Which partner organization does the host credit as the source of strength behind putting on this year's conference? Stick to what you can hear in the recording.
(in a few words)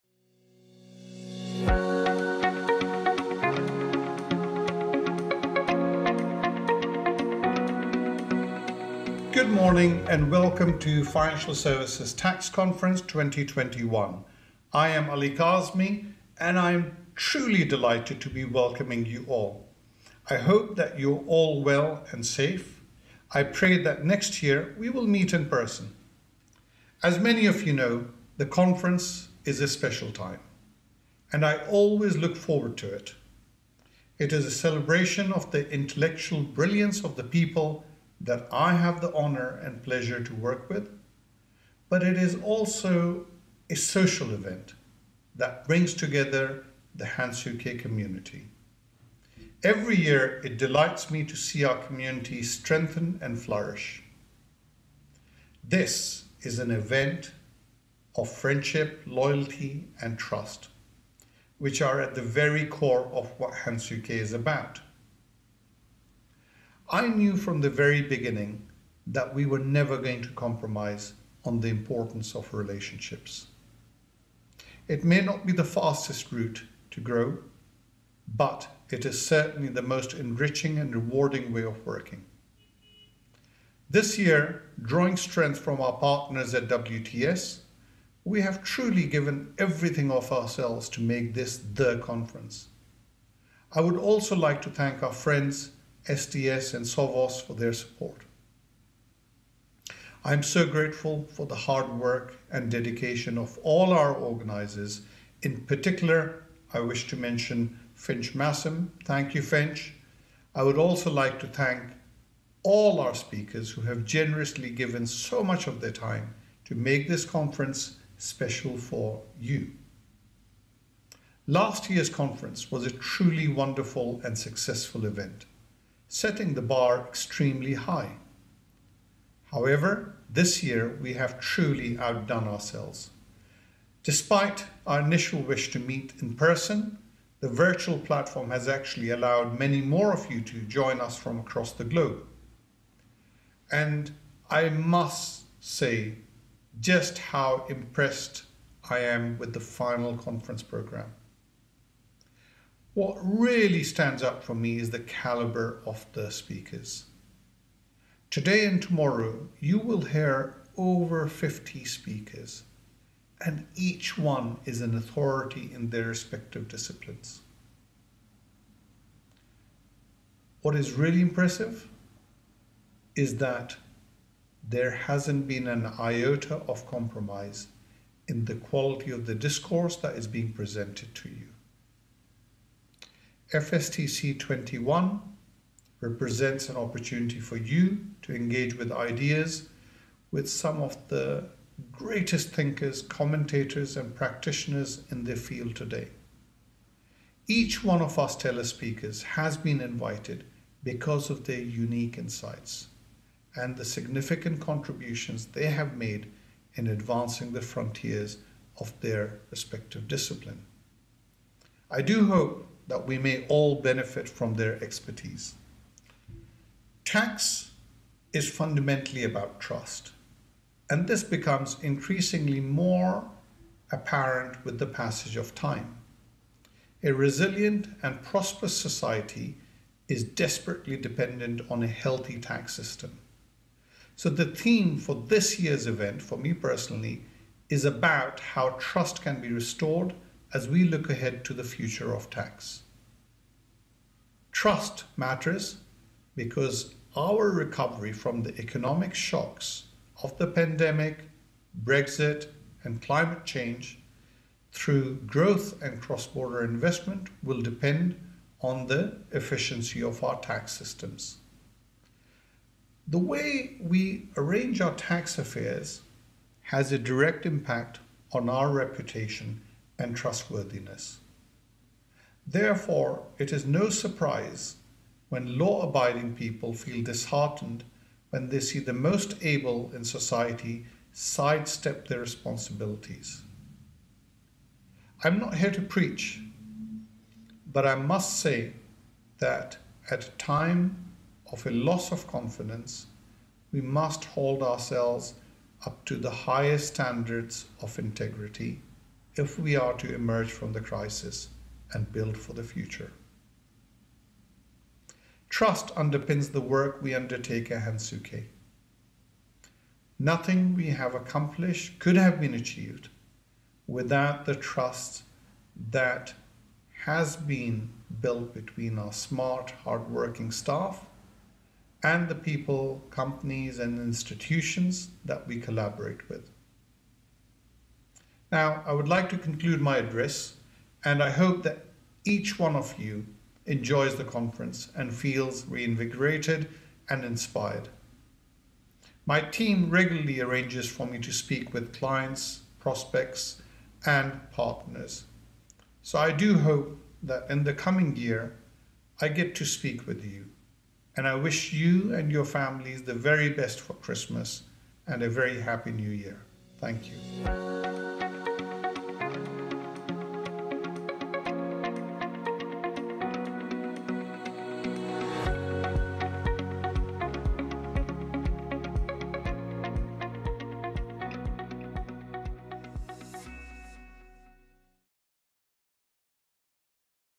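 WTS.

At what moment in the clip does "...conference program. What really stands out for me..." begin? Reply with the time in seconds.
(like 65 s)
150 s.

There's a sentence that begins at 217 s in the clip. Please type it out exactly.
Tax is fundamentally about trust, and this becomes increasingly more apparent with the passage of time.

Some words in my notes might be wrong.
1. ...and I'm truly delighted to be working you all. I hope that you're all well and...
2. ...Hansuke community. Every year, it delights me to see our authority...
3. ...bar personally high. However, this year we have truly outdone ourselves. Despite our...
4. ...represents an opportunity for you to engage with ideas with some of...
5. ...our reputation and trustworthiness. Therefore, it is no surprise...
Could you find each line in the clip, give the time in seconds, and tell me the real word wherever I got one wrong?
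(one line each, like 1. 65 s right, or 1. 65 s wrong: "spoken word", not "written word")
1. 16 s wrong: "welcoming", not "working"
2. 47 s wrong: "community", not "authority"
3. 126 s wrong: "extremely", not "personally"
4. 185 s right
5. 268 s right.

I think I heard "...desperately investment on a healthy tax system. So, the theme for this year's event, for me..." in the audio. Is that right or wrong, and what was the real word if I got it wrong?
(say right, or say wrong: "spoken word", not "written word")
wrong: "dependent", not "investment".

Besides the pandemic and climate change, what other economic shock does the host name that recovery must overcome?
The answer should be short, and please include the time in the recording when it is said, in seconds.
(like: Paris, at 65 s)
Brexit, at 251 s.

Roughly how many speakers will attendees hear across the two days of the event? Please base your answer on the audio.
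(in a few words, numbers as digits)
Over 50.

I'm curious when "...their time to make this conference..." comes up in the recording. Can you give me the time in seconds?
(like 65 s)
115 s.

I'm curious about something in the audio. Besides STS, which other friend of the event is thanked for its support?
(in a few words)
SOVOS.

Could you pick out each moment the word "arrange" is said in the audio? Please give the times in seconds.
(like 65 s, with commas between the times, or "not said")
264 s, 340 s.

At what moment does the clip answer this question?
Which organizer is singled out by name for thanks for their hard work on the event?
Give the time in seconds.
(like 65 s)
107 s.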